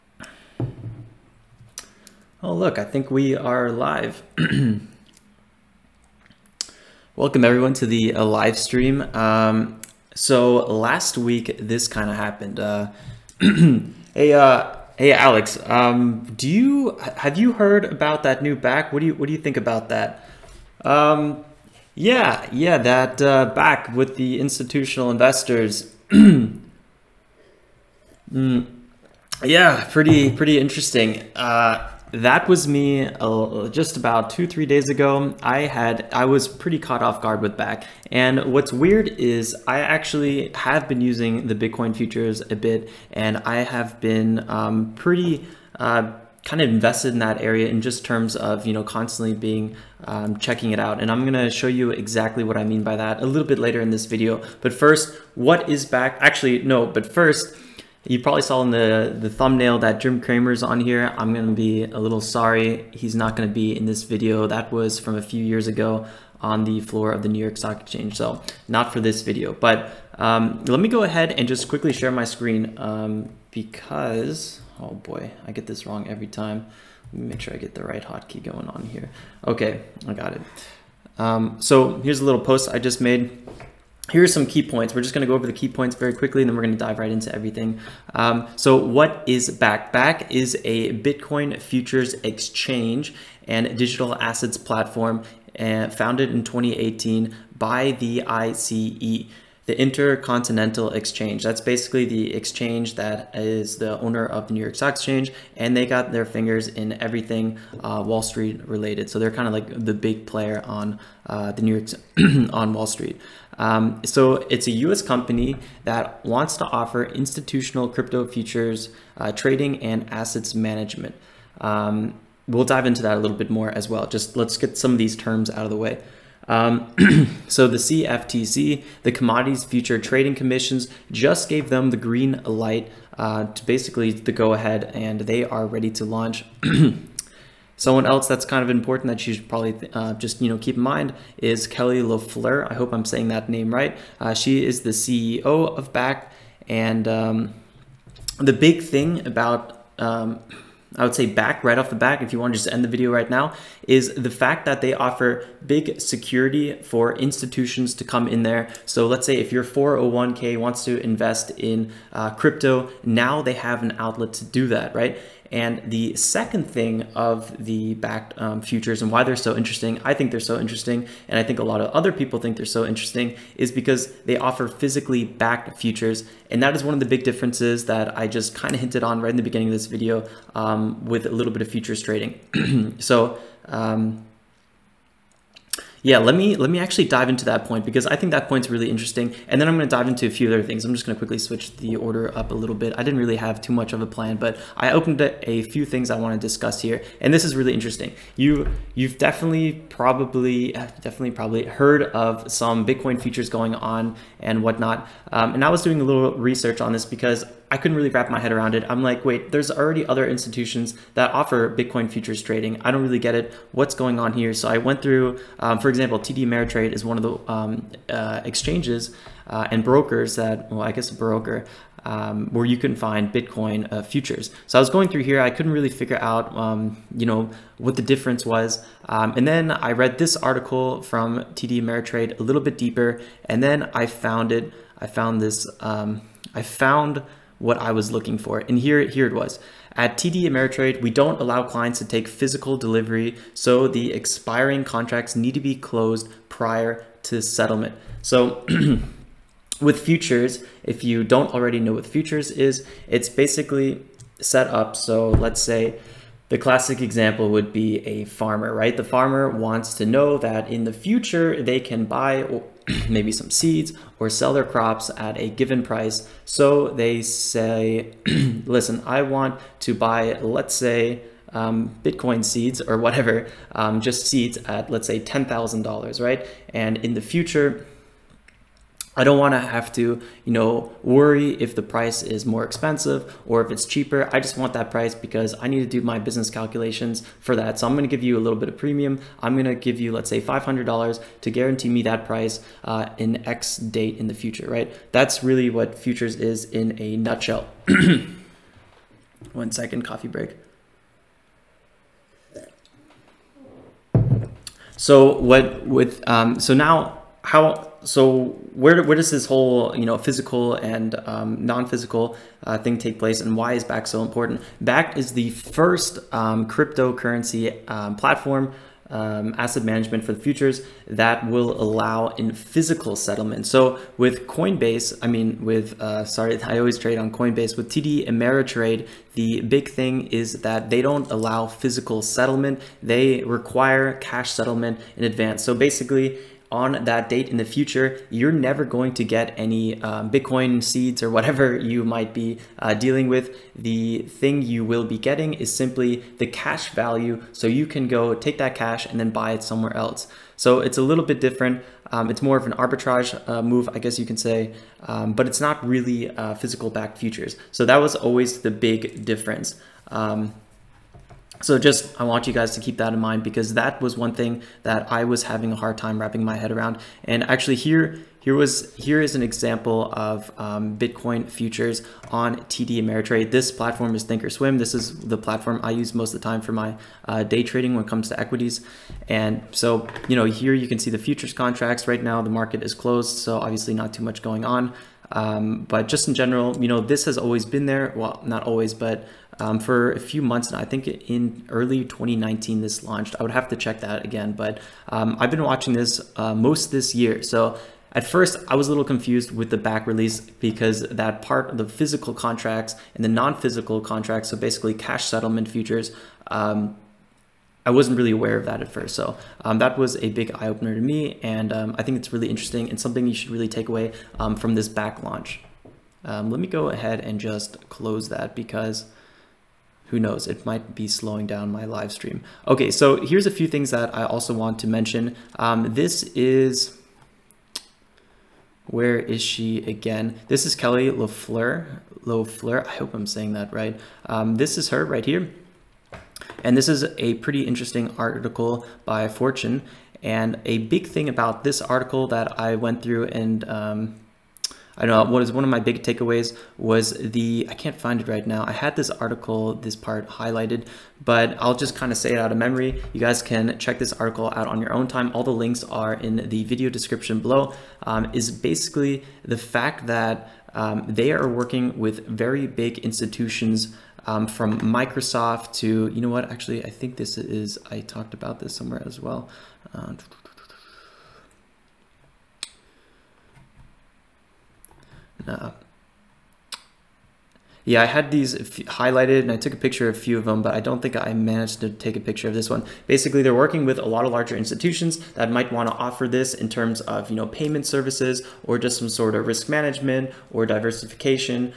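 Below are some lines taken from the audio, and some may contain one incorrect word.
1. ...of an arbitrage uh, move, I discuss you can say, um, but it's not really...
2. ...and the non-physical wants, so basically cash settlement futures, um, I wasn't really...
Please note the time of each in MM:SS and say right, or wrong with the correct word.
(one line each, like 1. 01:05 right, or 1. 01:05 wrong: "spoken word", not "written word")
1. 05:52 wrong: "guess", not "discuss"
2. 06:43 wrong: "contracts", not "wants".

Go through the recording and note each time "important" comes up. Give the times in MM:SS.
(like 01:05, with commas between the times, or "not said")
02:18, 05:14.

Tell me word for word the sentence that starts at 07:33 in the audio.
You guys can check this article out on your own time.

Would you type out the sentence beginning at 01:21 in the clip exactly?
Um, so here's a little post I just made here are some key points.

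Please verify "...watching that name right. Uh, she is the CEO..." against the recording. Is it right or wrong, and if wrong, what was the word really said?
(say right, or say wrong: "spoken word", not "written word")
wrong: "saying", not "watching".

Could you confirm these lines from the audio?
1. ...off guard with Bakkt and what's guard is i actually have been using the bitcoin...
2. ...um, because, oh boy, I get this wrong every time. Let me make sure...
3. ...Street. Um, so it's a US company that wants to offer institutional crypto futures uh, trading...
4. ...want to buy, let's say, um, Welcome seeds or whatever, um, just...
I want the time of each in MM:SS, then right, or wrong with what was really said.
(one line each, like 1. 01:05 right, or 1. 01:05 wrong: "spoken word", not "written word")
1. 00:37 wrong: "weird", not "guard"
2. 01:12 right
3. 01:52 right
4. 04:29 wrong: "Bitcoin", not "Welcome".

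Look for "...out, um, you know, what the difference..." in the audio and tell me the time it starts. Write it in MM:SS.
03:46.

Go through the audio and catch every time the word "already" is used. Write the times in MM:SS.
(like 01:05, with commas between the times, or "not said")
03:29, 04:11.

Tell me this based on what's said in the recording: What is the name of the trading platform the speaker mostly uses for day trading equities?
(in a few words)
Thinkorswim.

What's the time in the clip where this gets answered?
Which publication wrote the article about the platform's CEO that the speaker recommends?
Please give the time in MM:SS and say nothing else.
07:19.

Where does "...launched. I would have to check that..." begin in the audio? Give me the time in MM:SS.
06:33.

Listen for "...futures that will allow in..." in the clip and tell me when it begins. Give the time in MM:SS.
05:20.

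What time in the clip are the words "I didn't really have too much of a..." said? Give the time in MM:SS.
03:12.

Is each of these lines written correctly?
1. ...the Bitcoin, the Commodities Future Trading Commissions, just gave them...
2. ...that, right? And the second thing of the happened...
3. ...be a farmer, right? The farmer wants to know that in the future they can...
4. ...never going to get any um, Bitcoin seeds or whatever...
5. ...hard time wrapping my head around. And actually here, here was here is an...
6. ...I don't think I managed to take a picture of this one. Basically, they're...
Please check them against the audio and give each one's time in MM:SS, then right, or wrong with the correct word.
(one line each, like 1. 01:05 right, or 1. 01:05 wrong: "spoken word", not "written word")
1. 02:07 wrong: "CFTC", not "Bitcoin"
2. 02:44 wrong: "backed", not "happened"
3. 04:17 right
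4. 05:38 right
5. 06:05 right
6. 08:00 right.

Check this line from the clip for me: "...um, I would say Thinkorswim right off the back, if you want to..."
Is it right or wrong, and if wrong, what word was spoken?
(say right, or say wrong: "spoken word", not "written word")
wrong: "Bakkt", not "Thinkorswim".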